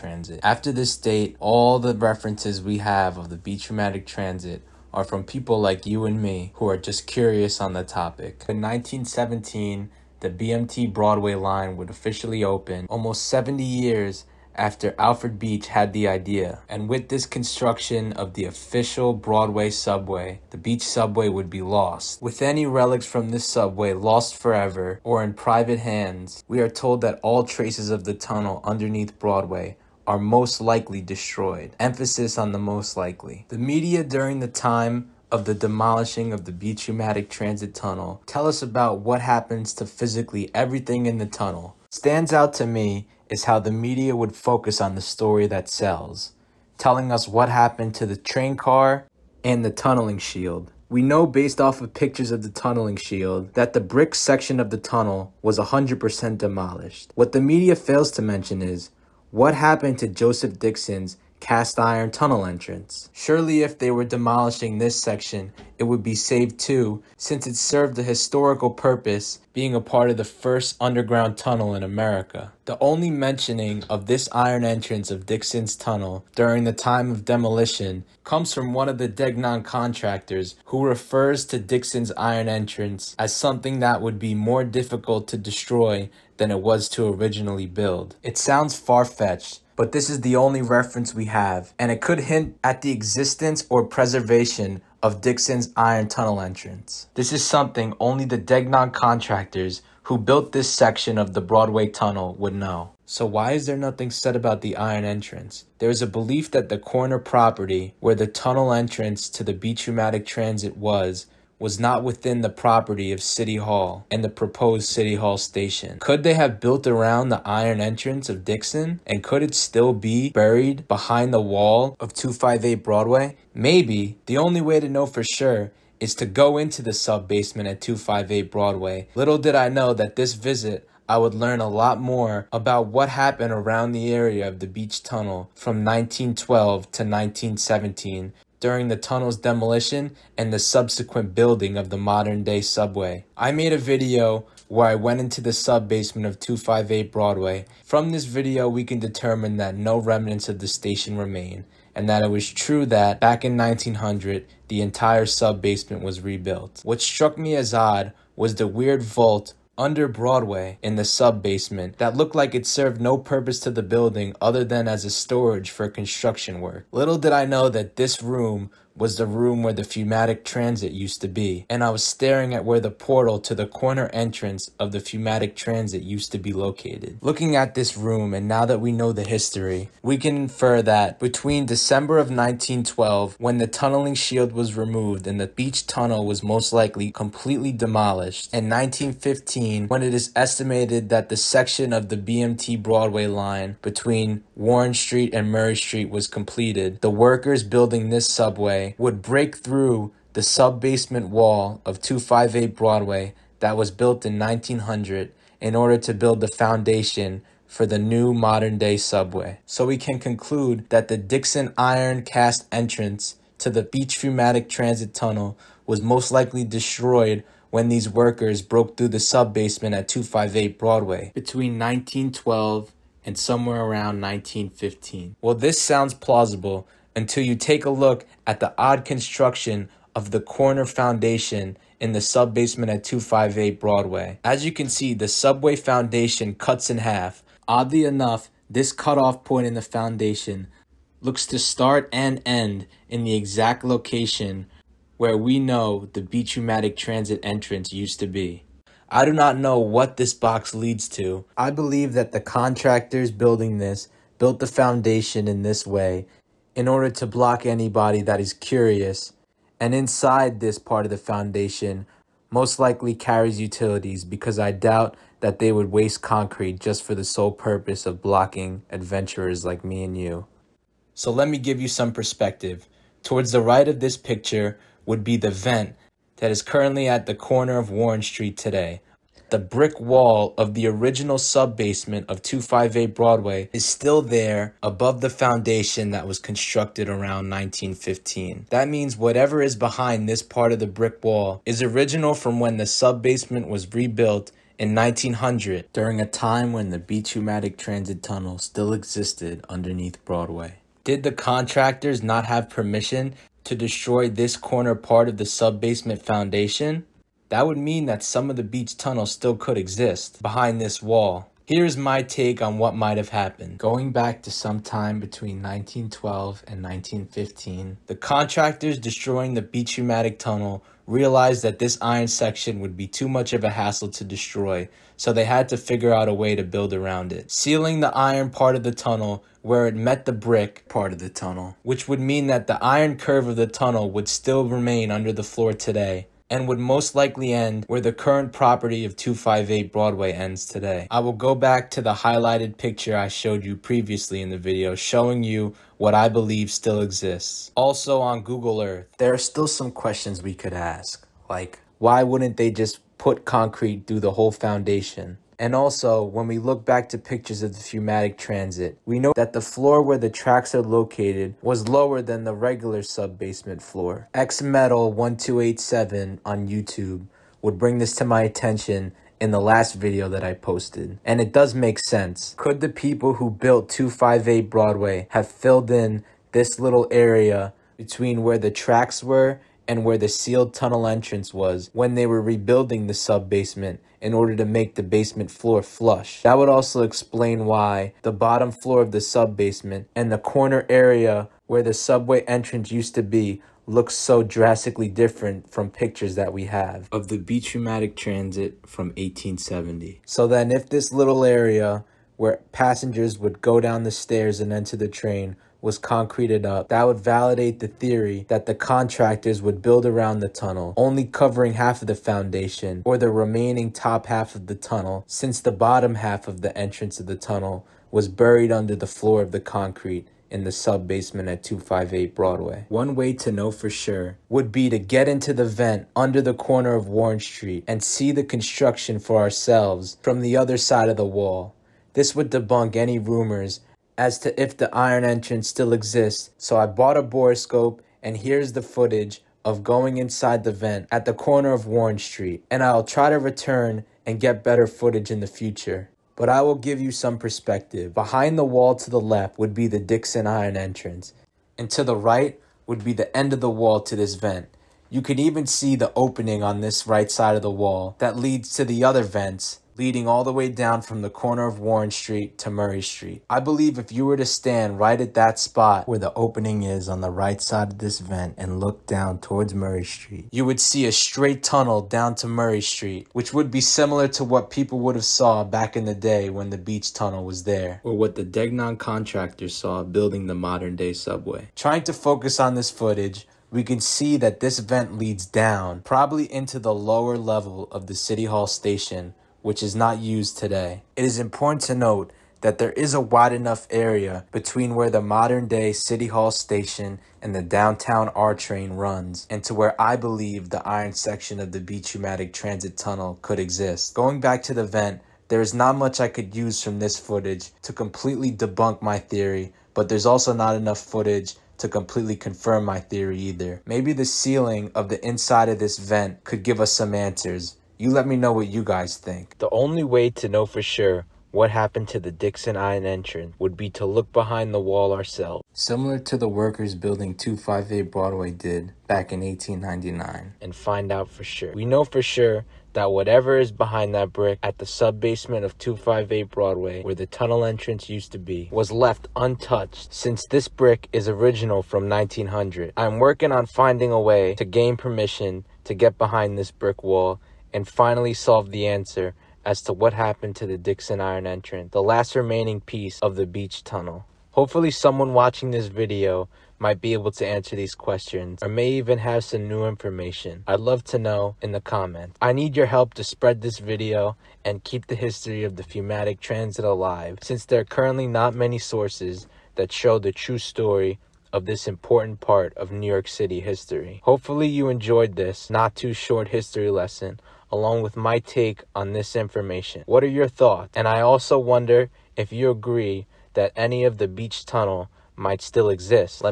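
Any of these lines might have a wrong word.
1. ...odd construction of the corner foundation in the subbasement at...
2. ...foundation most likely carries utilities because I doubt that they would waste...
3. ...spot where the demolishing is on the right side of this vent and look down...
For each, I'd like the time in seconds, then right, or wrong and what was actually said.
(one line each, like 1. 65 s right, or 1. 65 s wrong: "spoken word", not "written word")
1. 228 s right
2. 261 s right
3. 465 s wrong: "opening", not "demolishing".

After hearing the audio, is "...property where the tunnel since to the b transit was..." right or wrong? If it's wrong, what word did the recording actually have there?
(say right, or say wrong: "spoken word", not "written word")
wrong: "entrance", not "since".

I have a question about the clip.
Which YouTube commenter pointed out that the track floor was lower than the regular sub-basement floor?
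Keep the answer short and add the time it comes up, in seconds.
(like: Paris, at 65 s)
XMetal1287, at 364 s.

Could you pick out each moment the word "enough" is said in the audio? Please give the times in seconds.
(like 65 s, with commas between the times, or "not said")
238 s, 493 s, 510 s.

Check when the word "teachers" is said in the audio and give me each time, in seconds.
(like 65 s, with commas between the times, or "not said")
not said.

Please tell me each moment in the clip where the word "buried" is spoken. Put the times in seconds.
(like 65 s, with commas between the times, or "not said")
120 s, 418 s.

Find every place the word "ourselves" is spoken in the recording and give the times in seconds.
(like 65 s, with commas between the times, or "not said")
429 s, 525 s.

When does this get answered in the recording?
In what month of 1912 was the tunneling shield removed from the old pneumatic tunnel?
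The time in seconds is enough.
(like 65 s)
181 s.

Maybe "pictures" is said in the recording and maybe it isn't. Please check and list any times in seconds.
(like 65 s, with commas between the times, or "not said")
51 s, 274 s, 342 s, 357 s, 395 s.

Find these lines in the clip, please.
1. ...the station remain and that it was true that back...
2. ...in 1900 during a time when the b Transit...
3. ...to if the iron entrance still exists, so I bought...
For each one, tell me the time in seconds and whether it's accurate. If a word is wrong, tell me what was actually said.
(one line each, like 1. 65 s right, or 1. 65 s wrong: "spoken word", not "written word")
1. 150 s right
2. 294 s right
3. 434 s right.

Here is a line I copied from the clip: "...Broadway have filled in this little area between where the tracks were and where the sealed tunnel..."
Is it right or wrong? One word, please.
right.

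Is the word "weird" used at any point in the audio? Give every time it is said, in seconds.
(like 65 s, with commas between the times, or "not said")
158 s.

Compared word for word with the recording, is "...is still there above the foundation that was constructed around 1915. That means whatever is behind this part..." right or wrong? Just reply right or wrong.
right.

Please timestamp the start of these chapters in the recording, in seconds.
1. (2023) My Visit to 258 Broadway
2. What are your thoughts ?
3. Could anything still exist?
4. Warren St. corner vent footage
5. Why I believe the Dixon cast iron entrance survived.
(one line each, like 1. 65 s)
1. 119 s
2. 552 s
3. 29 s
4. 419 s
5. 309 s.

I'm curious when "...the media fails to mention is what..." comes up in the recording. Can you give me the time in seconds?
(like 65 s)
57 s.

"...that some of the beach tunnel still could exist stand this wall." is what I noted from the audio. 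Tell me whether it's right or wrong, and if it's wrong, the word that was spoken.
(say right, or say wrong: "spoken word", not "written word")
wrong: "behind", not "stand".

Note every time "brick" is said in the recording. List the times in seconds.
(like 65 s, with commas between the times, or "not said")
53 s, 279 s, 290 s, 330 s, 534 s, 540 s, 546 s.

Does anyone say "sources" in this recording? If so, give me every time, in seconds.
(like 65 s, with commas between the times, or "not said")
568 s.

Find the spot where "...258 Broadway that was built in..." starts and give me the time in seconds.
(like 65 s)
201 s.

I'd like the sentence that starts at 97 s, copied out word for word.
This is something only the Degnon contractors who built this section of the Broadway tunnel would know.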